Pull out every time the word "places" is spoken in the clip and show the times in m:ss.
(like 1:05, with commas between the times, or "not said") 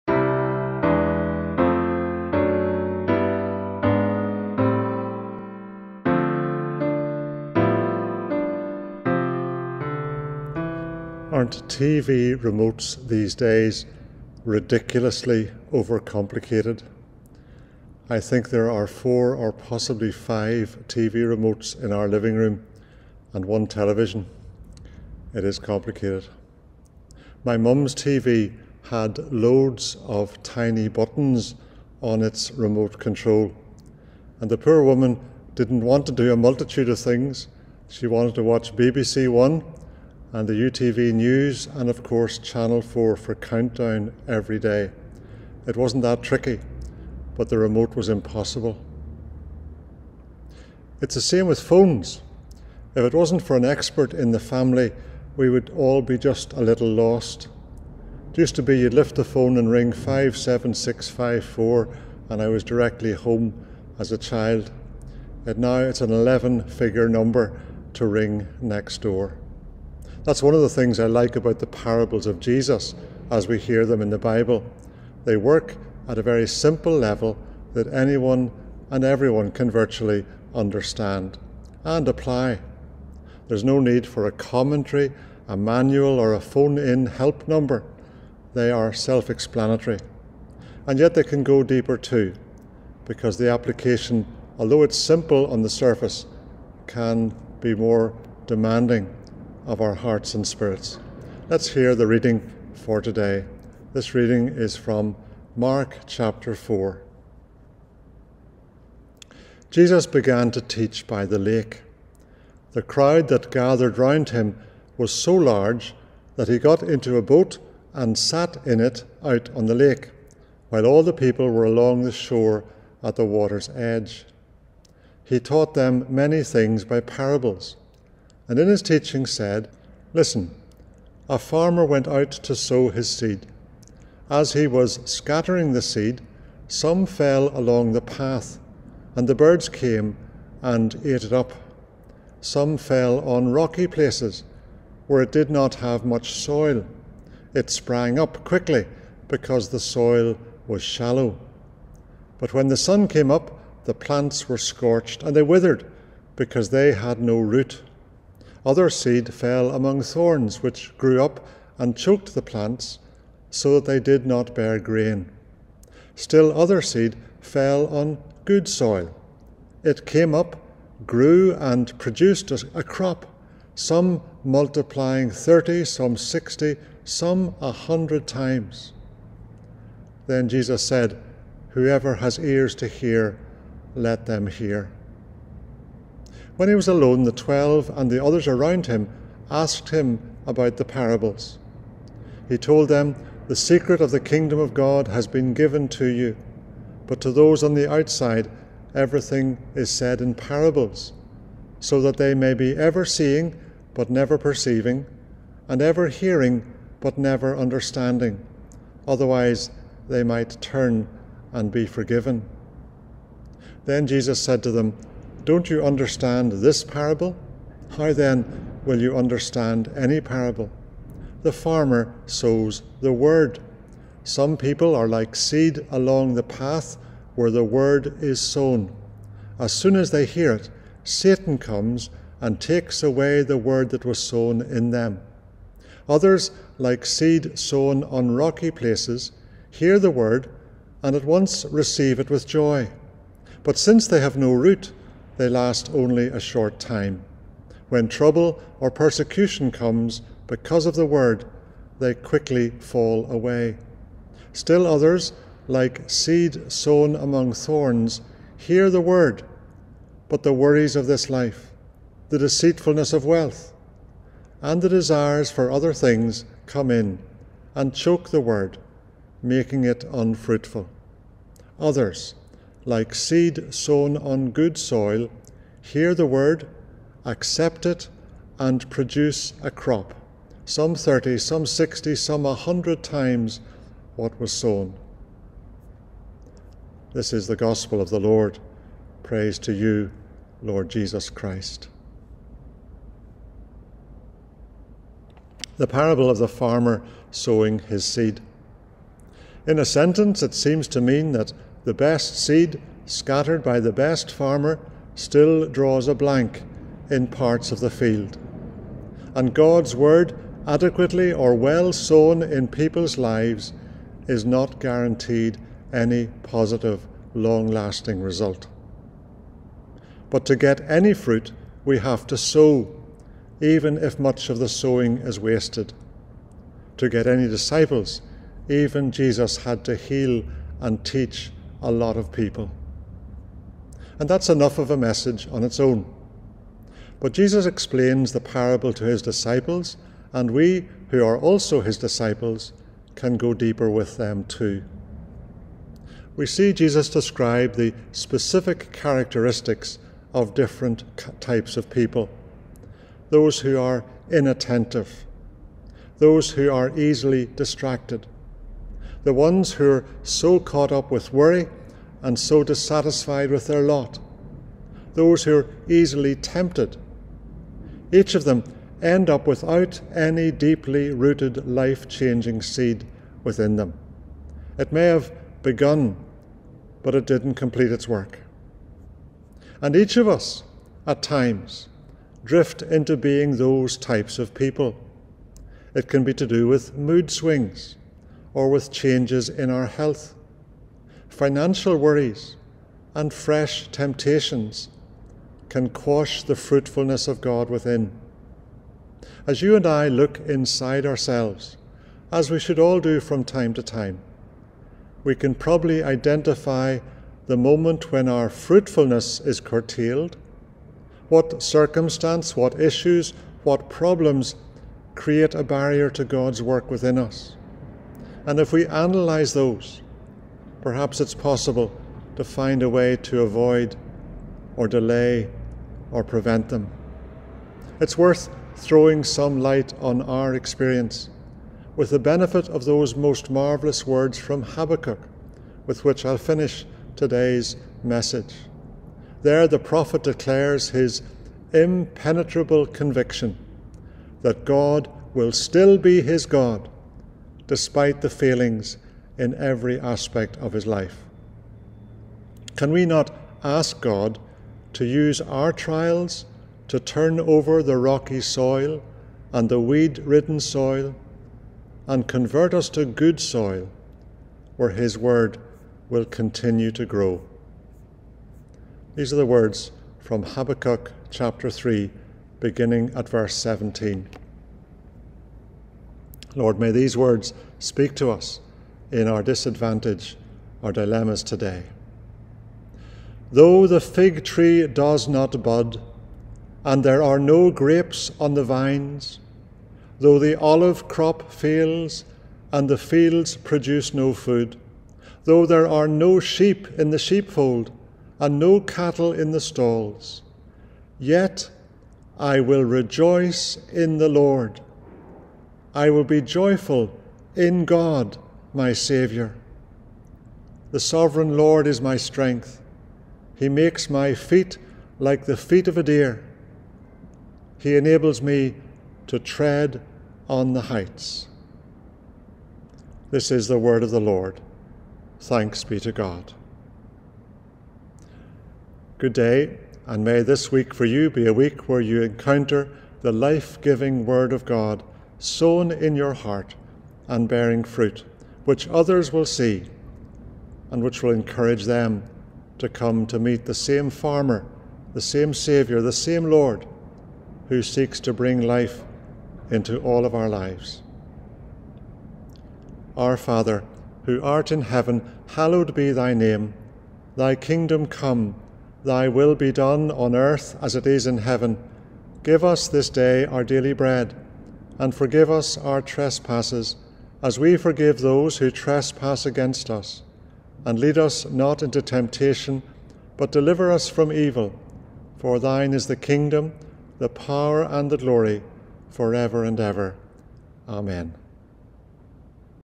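2:23, 3:58.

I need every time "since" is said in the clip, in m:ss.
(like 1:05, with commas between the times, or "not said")
4:03.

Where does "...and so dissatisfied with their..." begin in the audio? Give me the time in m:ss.
6:02.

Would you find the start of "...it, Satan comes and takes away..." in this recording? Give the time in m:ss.
3:50.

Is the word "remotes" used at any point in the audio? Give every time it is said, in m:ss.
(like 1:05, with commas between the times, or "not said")
0:12, 0:21, 0:32, 0:47.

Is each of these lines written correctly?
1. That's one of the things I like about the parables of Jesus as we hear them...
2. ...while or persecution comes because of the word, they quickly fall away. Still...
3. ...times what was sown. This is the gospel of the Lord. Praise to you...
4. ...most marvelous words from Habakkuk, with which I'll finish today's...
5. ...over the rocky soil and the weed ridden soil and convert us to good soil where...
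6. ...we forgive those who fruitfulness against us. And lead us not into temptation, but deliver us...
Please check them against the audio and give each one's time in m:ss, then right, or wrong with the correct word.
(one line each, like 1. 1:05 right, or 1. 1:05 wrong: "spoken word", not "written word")
1. 1:10 right
2. 4:08 wrong: "trouble", not "while"
3. 4:43 right
4. 7:13 right
5. 7:37 right
6. 9:27 wrong: "trespass", not "fruitfulness".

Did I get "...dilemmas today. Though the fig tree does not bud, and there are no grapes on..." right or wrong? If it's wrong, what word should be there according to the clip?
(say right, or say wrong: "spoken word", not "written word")
right.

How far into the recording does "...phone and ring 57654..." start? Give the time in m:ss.
0:59.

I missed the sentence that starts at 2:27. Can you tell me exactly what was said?
It sprang up quickly, because the soil was shallow.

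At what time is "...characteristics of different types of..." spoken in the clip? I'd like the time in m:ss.
5:48.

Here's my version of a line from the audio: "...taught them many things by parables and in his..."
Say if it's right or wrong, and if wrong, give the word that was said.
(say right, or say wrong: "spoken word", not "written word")
right.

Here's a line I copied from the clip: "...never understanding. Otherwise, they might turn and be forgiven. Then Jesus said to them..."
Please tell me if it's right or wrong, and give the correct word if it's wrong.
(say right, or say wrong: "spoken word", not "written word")
right.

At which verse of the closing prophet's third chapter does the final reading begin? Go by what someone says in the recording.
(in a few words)
17.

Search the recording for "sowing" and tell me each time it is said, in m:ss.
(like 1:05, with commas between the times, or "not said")
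4:57, 5:24.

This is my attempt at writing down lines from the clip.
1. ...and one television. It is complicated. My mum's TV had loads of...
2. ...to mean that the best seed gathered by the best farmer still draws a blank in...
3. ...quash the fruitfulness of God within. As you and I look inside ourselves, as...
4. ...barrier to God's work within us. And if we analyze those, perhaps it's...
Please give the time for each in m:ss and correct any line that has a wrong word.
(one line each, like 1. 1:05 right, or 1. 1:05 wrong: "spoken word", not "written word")
1. 0:23 right
2. 5:00 wrong: "scattered", not "gathered"
3. 6:35 right
4. 6:55 right.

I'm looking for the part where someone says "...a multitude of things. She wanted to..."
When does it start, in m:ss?
0:36.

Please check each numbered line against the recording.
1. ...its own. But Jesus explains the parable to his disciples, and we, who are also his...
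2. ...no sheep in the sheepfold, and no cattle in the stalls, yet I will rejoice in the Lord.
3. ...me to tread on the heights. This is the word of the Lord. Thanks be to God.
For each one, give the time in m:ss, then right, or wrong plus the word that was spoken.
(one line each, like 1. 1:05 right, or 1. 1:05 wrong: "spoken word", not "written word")
1. 5:35 right
2. 8:16 right
3. 8:38 right.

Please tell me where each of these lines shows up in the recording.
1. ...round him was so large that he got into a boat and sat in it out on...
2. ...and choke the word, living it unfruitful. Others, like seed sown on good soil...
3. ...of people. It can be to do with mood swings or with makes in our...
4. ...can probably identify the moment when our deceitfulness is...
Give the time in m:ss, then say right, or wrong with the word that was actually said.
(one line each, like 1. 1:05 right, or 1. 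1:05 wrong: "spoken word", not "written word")
1. 1:53 right
2. 4:27 wrong: "making", not "living"
3. 6:24 wrong: "changes", not "makes"
4. 6:45 wrong: "fruitfulness", not "deceitfulness".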